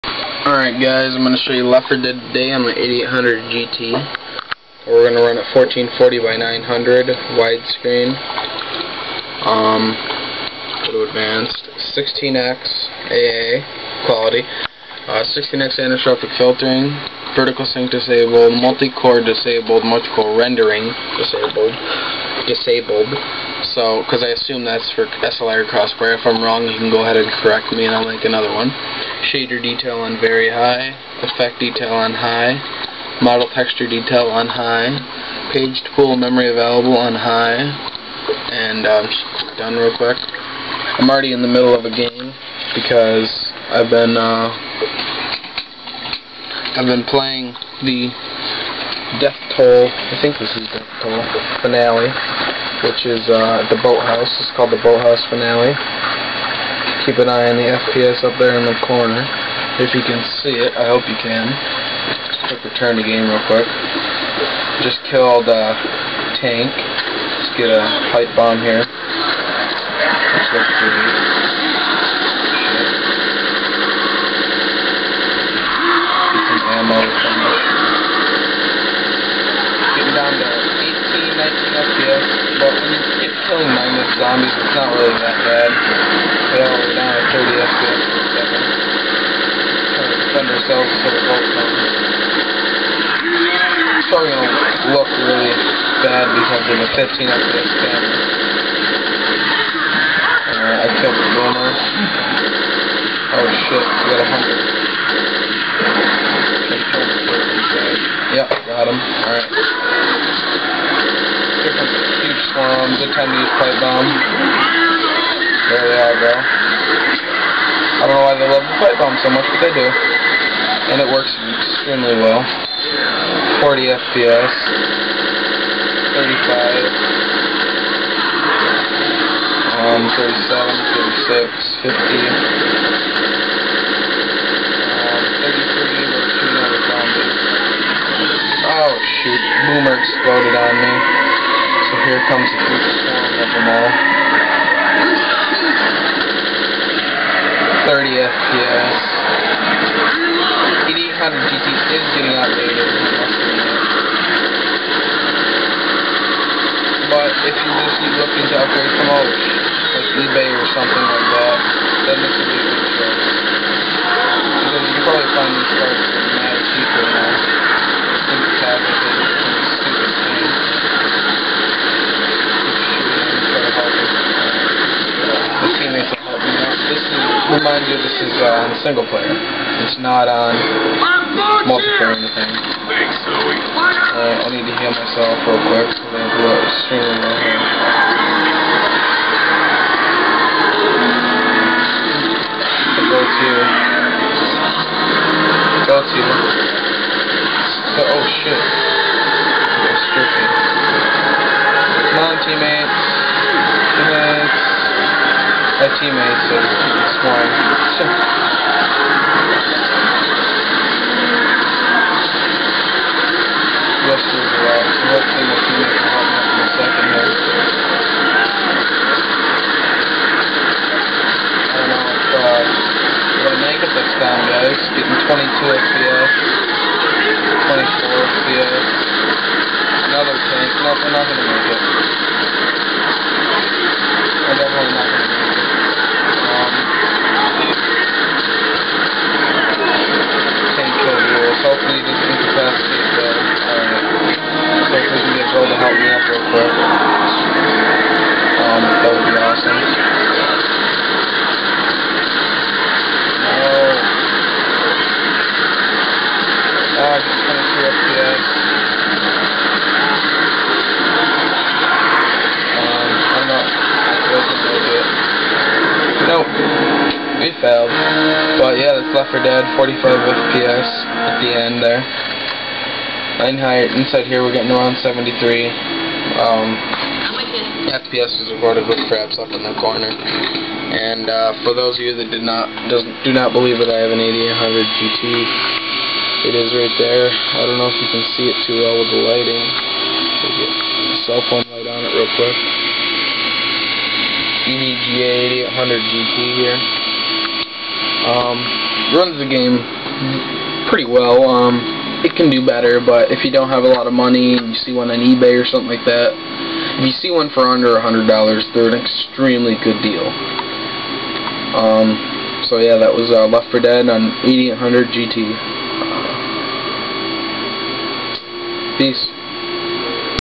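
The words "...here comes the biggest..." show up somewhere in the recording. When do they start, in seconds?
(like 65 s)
142 s.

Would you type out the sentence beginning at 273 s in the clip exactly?
9 height, inside here we're getting around 73.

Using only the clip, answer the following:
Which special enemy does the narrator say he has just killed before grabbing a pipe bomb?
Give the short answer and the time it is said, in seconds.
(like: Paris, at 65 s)
Tank, at 66 s.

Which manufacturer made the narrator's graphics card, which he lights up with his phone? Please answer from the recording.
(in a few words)
EVGA.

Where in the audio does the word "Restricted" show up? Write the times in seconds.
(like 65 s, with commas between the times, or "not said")
199 s.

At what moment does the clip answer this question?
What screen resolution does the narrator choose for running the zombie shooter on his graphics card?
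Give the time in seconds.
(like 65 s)
5 s.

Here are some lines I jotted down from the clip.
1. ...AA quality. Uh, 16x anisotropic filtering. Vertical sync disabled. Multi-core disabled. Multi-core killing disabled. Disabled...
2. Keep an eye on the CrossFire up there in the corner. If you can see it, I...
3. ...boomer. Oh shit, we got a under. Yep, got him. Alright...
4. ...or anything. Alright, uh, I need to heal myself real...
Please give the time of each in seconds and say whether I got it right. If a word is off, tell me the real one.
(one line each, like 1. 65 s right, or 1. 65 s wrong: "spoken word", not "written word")
1. 13 s wrong: "rendering", not "killing"
2. 57 s wrong: "FPS", not "CrossFire"
3. 101 s wrong: "hunter", not "under"
4. 182 s right.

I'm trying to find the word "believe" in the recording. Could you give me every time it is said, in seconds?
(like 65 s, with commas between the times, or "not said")
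283 s.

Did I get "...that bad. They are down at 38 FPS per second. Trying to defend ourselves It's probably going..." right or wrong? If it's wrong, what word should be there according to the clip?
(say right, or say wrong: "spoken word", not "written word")
wrong: "30", not "38".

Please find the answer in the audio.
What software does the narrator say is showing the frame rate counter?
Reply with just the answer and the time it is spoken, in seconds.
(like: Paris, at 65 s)
Fraps, at 279 s.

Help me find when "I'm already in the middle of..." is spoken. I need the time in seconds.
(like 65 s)
40 s.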